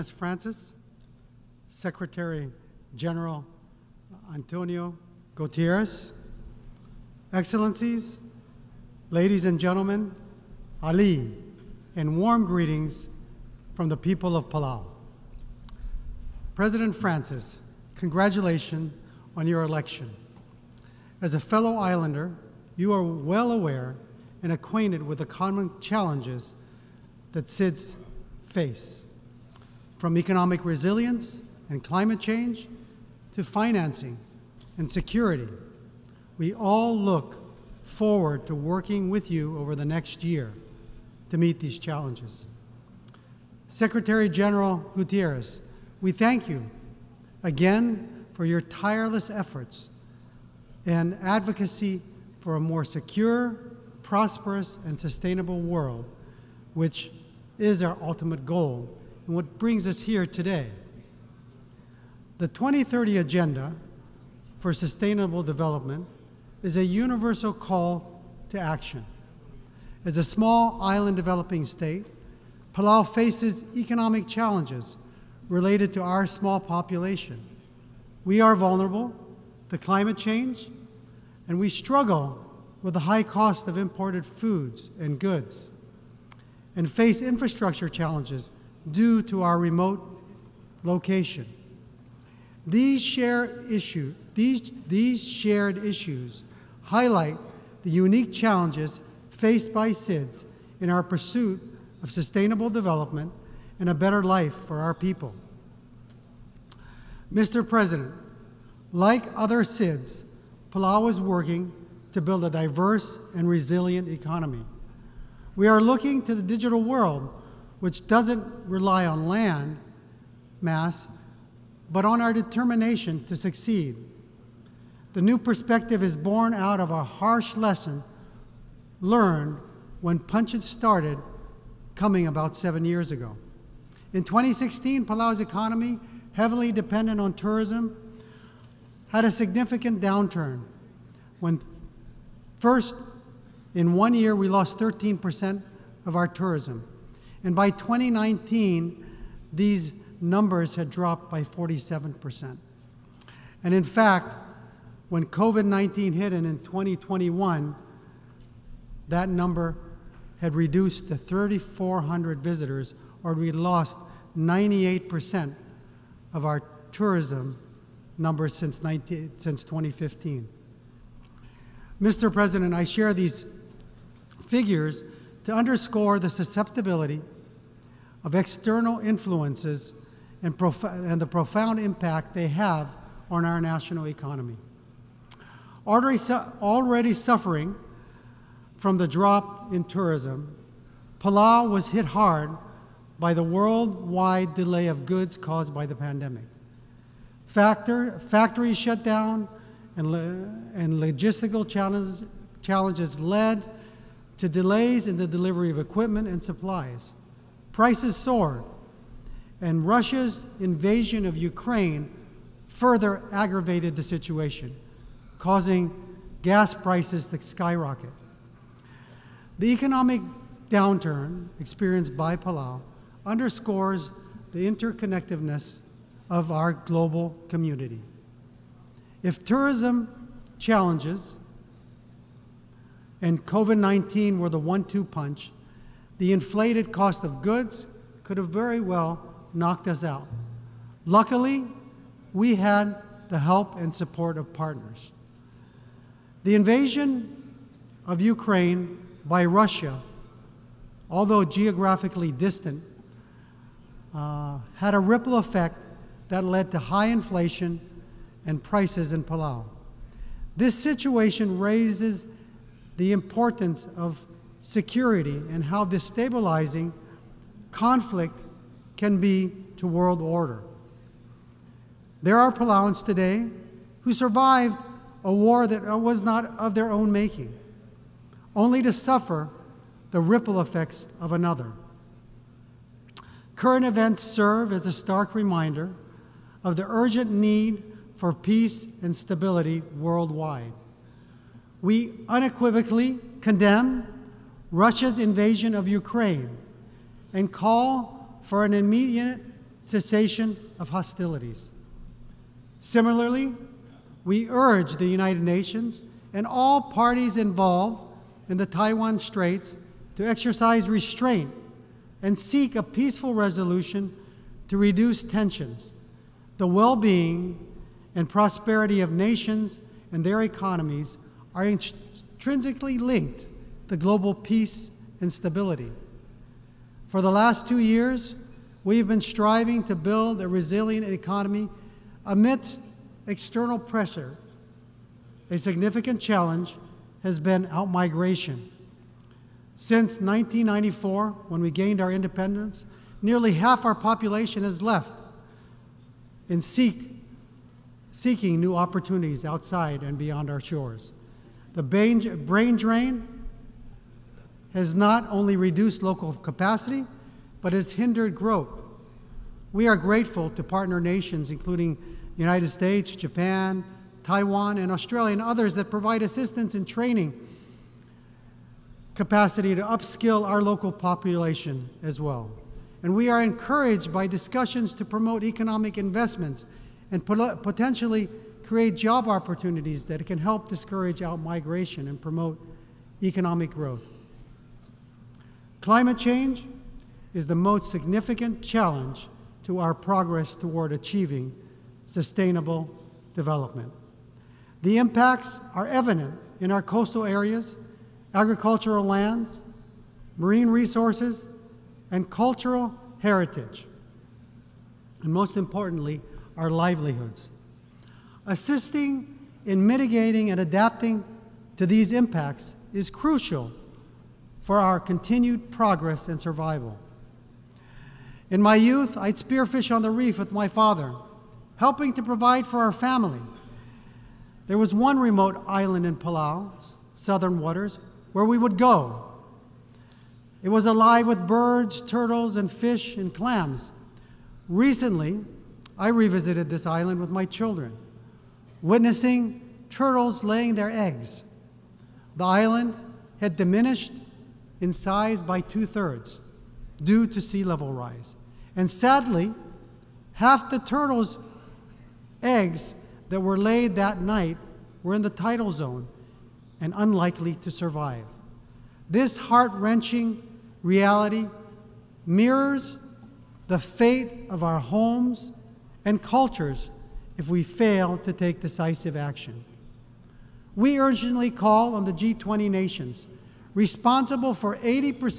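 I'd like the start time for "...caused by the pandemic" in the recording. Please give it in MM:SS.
03:15.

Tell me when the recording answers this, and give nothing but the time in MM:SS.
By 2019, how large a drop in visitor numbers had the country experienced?
02:31.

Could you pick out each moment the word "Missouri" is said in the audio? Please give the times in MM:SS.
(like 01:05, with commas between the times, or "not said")
not said.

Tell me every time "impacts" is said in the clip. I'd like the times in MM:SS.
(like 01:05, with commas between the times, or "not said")
03:01, 06:34, 06:52.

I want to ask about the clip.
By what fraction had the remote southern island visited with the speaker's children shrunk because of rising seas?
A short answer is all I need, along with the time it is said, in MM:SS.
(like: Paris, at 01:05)
two thirds, at 07:25.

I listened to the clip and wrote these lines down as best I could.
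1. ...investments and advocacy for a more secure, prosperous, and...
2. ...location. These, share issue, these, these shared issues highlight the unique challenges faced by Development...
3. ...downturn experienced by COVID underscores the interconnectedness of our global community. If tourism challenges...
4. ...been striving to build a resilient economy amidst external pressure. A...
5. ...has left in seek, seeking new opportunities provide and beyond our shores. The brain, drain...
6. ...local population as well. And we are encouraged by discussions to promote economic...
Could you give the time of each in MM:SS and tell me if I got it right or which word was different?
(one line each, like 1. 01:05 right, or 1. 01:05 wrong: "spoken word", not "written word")
1. 00:49 wrong: "efforts", not "investments"
2. 01:30 wrong: "SIDS", not "Development"
3. 03:40 wrong: "Palau", not "COVID"
4. 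05:29 right
5. 05:44 wrong: "outside", not "provide"
6. 06:10 right.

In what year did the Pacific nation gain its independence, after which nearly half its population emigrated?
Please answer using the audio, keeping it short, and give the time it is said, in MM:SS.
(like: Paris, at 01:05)
1994, at 05:40.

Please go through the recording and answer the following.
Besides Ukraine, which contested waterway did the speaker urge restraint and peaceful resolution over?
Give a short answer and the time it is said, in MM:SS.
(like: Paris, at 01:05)
Taiwan Straits, at 05:08.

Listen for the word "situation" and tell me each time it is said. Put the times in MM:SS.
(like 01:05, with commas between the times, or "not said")
03:34, 04:20.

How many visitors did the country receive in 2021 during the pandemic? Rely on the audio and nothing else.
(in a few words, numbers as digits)
3,400.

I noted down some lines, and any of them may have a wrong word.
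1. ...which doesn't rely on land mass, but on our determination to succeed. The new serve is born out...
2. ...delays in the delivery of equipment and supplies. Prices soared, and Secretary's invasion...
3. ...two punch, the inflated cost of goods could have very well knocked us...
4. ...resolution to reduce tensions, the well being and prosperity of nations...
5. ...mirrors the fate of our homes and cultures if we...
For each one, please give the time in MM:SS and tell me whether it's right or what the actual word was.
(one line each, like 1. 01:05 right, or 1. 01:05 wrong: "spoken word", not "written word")
1. 01:57 wrong: "perspective", not "serve"
2. 03:24 wrong: "Russia", not "Secretary"
3. 03:54 right
4. 05:13 right
5. 07:42 right.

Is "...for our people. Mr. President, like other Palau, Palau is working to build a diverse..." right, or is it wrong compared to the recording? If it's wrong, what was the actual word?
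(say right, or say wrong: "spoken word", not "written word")
wrong: "SIDS", not "Palau".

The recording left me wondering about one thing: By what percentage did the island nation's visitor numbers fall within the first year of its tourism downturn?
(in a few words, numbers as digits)
13%.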